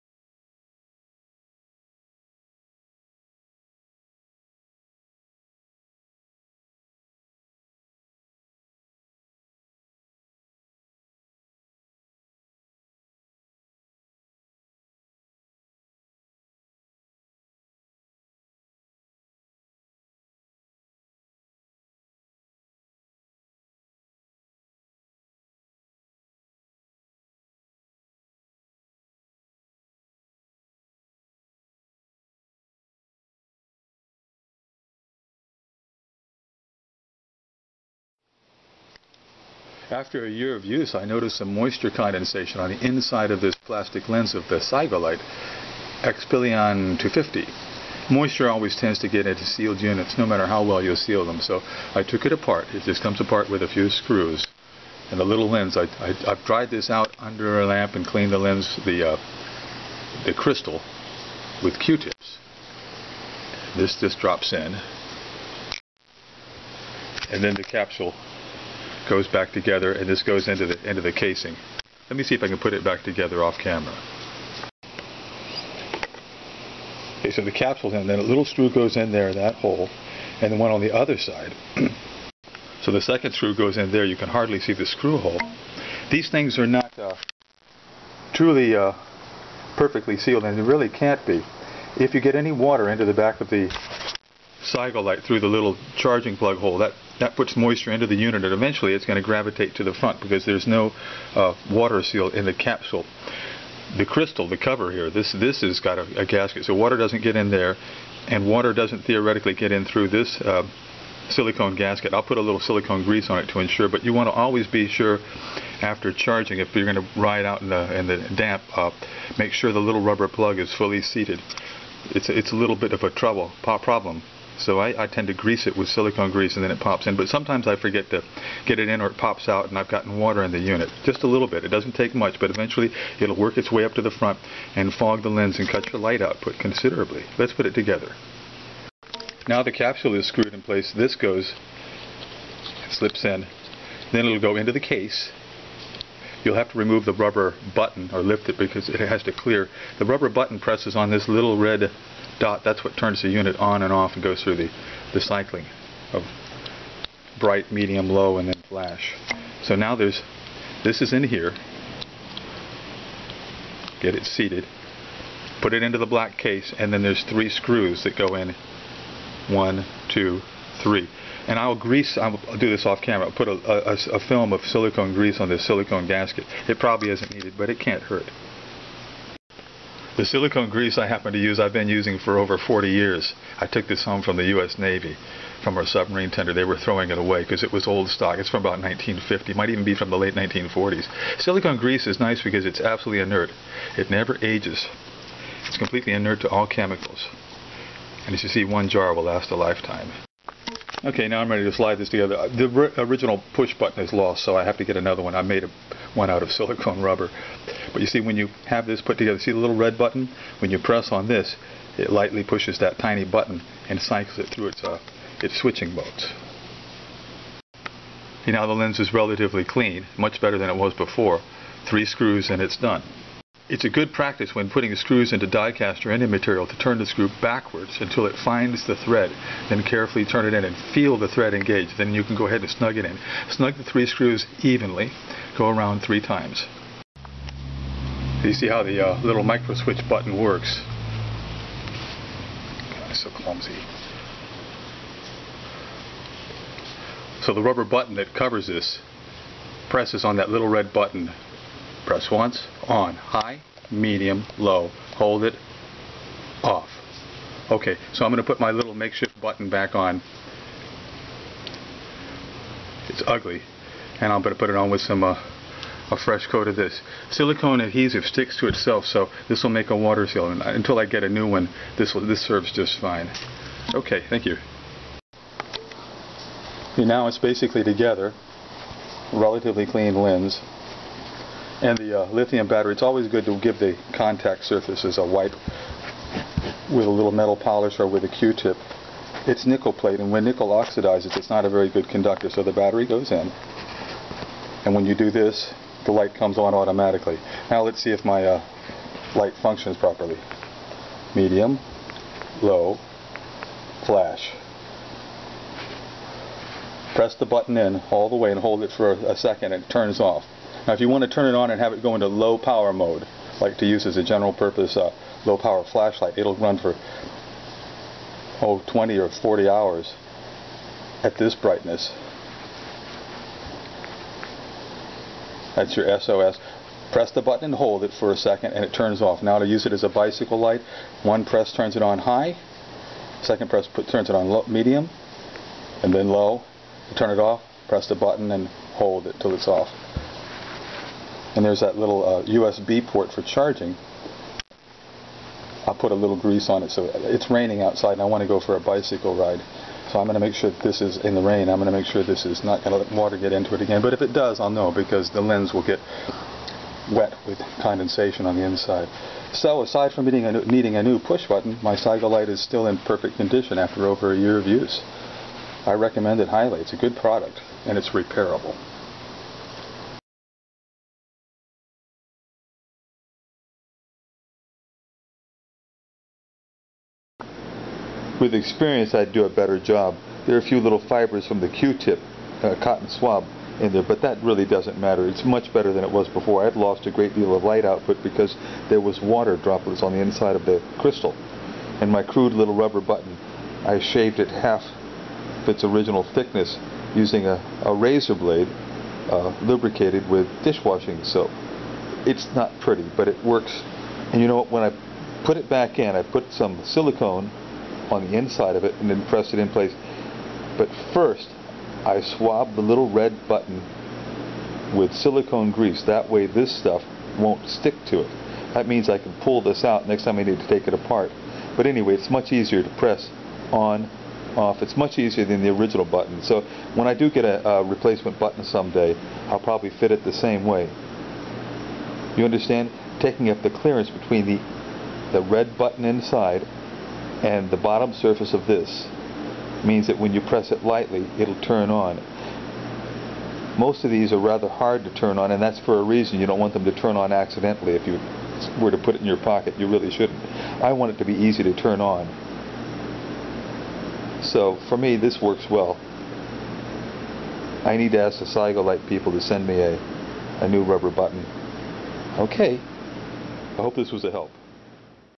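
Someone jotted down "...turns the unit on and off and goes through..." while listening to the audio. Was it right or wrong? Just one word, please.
right.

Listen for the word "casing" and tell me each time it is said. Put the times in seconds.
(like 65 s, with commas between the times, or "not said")
71 s.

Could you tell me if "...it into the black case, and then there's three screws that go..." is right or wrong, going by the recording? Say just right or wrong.
right.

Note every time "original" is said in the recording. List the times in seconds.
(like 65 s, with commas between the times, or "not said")
202 s, 395 s, 425 s.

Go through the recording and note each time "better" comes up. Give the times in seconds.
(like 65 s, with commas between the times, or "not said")
220 s, 379 s, 385 s.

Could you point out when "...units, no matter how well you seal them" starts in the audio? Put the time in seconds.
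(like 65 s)
49 s.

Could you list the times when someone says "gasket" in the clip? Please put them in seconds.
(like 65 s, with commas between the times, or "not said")
106 s, 111 s, 176 s.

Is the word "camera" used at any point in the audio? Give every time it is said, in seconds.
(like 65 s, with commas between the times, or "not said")
73 s, 173 s.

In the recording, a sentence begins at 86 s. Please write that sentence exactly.
These things are not uh, truly uh, perfectly sealed, and they really can't be.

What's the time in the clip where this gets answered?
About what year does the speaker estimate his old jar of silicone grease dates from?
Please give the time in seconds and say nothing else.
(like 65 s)
188 s.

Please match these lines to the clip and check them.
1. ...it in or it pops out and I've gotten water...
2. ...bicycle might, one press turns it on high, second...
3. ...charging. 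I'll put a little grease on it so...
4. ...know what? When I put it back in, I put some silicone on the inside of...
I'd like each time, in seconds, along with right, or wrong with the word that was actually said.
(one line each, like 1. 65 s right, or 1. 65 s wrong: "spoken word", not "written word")
1. 128 s right
2. 330 s wrong: "light", not "might"
3. 343 s right
4. 404 s right.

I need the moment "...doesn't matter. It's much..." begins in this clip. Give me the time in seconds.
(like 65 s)
384 s.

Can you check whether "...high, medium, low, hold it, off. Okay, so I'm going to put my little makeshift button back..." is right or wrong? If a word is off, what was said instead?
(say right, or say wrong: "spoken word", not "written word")
right.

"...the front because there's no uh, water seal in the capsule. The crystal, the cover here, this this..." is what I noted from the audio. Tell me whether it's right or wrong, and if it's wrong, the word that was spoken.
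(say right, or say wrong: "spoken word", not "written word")
right.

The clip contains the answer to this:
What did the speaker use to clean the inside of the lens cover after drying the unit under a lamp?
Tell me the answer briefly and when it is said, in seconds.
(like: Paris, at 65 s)
Q-tips, at 61 s.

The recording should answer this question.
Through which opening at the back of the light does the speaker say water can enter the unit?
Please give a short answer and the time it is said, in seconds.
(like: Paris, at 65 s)
charging plug hole, at 95 s.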